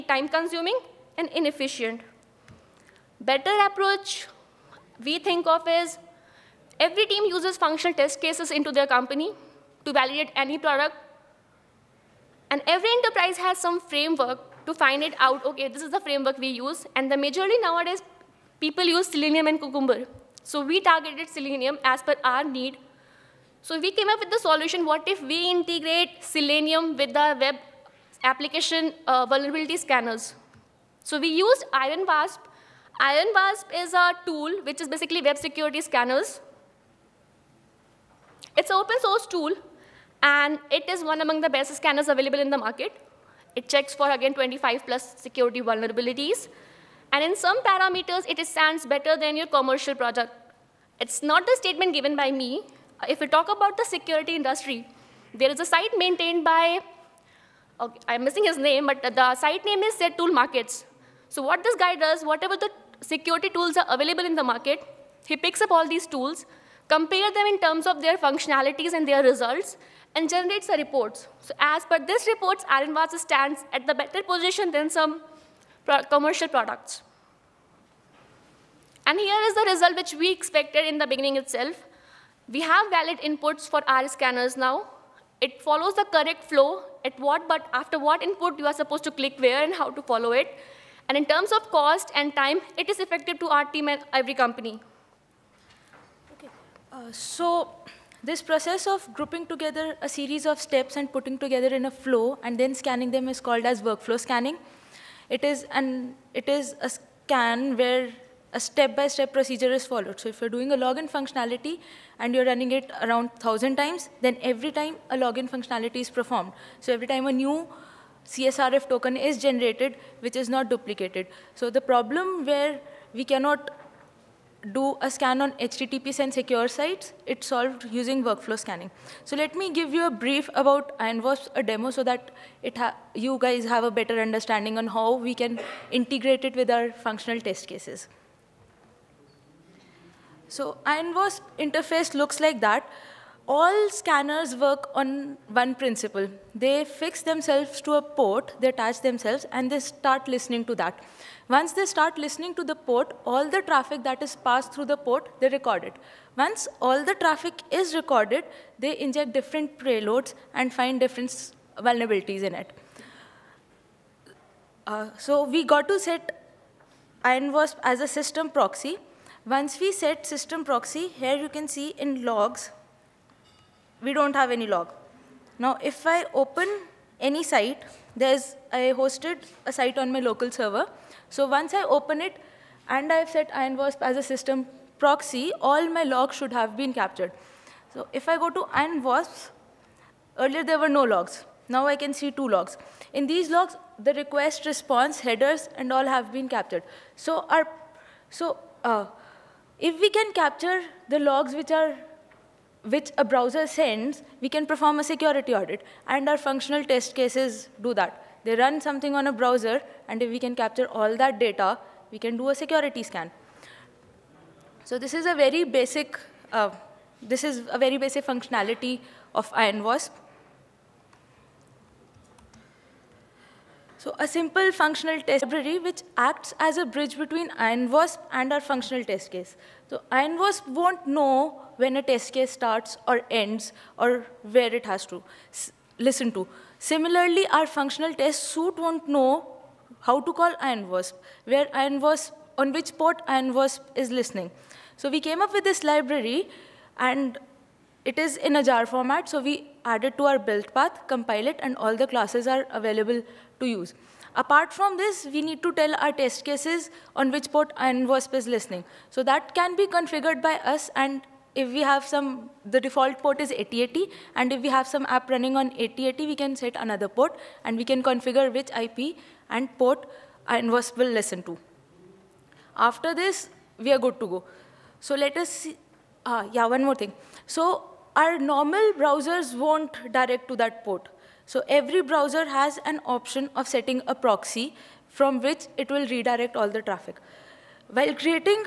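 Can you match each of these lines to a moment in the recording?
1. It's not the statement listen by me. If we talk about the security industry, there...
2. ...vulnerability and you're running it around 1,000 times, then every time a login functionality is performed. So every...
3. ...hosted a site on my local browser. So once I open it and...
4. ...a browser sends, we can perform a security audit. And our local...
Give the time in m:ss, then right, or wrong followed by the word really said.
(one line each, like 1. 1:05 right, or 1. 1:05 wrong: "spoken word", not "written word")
1. 0:51 wrong: "given", not "listen"
2. 1:51 wrong: "functionality", not "vulnerability"
3. 2:58 wrong: "server", not "browser"
4. 3:23 wrong: "functional", not "local".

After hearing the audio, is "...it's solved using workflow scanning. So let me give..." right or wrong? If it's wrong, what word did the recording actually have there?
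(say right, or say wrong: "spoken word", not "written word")
right.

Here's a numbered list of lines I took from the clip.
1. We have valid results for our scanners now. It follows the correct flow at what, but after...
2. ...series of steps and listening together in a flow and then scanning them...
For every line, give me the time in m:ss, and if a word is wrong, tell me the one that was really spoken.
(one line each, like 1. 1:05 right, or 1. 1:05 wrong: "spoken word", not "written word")
1. 1:22 wrong: "inputs", not "results"
2. 1:40 wrong: "putting", not "listening".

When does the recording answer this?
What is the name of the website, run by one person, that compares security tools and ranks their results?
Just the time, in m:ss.
1:00.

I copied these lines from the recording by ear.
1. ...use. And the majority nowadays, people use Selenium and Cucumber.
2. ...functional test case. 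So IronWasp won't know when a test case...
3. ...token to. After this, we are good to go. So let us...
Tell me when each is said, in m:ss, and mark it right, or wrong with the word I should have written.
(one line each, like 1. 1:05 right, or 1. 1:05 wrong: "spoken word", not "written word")
1. 0:16 right
2. 3:48 right
3. 4:30 wrong: "listen", not "token".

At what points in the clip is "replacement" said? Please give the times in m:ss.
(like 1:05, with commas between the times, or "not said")
not said.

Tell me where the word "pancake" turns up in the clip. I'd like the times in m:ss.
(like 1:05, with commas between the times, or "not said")
not said.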